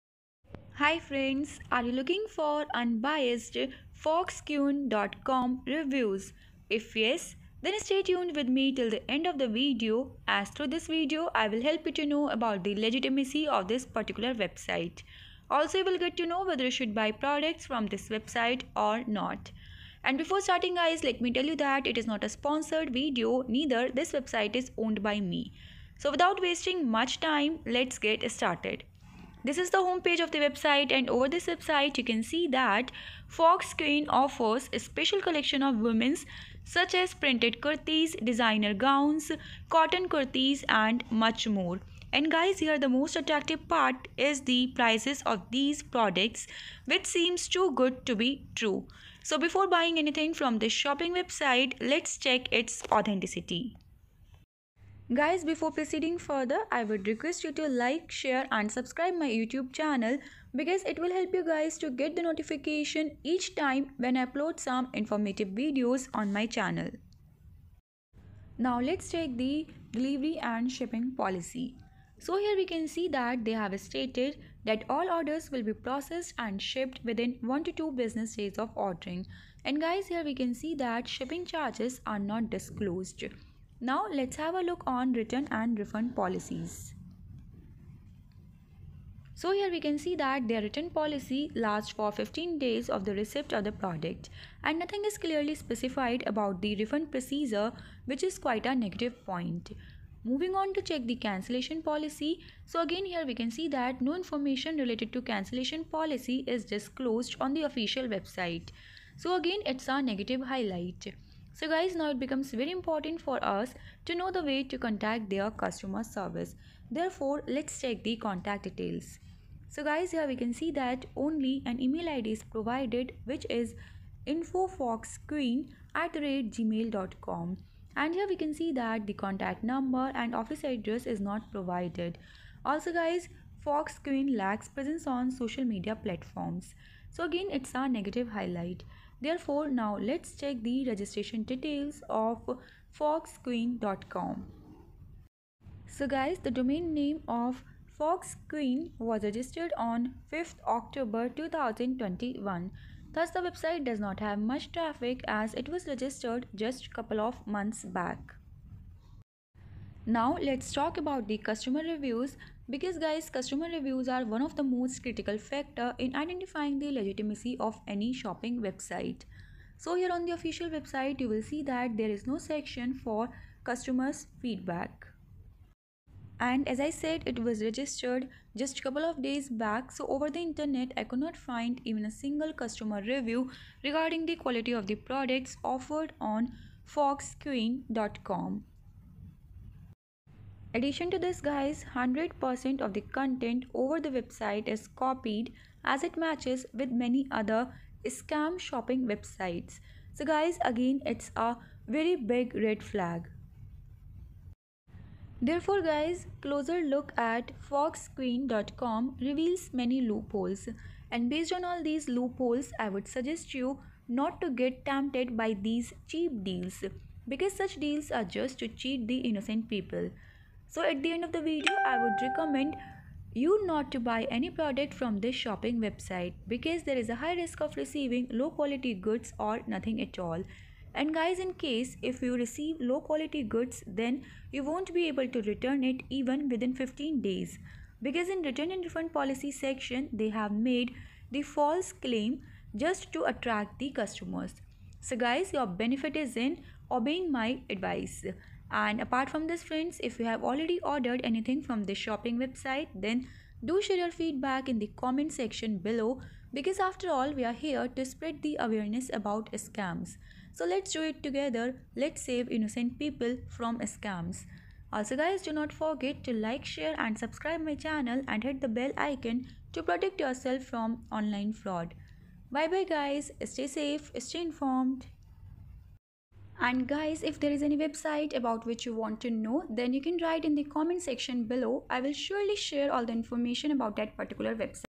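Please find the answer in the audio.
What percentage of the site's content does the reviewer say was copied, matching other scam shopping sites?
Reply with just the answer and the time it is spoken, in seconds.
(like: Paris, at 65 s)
100%, at 191 s.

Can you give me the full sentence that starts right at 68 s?
Now let's take the delivery and shipping policy.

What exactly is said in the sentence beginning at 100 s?
Moving on to check the cancellation policy.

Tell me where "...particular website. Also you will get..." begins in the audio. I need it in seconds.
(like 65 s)
13 s.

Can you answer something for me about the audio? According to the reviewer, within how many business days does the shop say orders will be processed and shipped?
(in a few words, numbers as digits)
1 to 2.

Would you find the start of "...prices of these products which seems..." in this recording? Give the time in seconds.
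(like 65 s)
44 s.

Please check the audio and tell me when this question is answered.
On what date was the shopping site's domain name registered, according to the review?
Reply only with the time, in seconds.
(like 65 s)
150 s.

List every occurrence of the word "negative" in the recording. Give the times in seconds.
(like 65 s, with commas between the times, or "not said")
98 s, 110 s, 137 s.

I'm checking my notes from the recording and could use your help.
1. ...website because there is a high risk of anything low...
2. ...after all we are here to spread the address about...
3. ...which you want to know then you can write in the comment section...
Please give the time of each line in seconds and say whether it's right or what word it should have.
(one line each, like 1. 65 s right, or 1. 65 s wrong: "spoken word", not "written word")
1. 225 s wrong: "receiving", not "anything"
2. 256 s wrong: "awareness", not "address"
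3. 278 s right.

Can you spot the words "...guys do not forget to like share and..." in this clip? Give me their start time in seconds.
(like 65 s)
265 s.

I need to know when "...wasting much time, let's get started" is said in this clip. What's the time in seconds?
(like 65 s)
26 s.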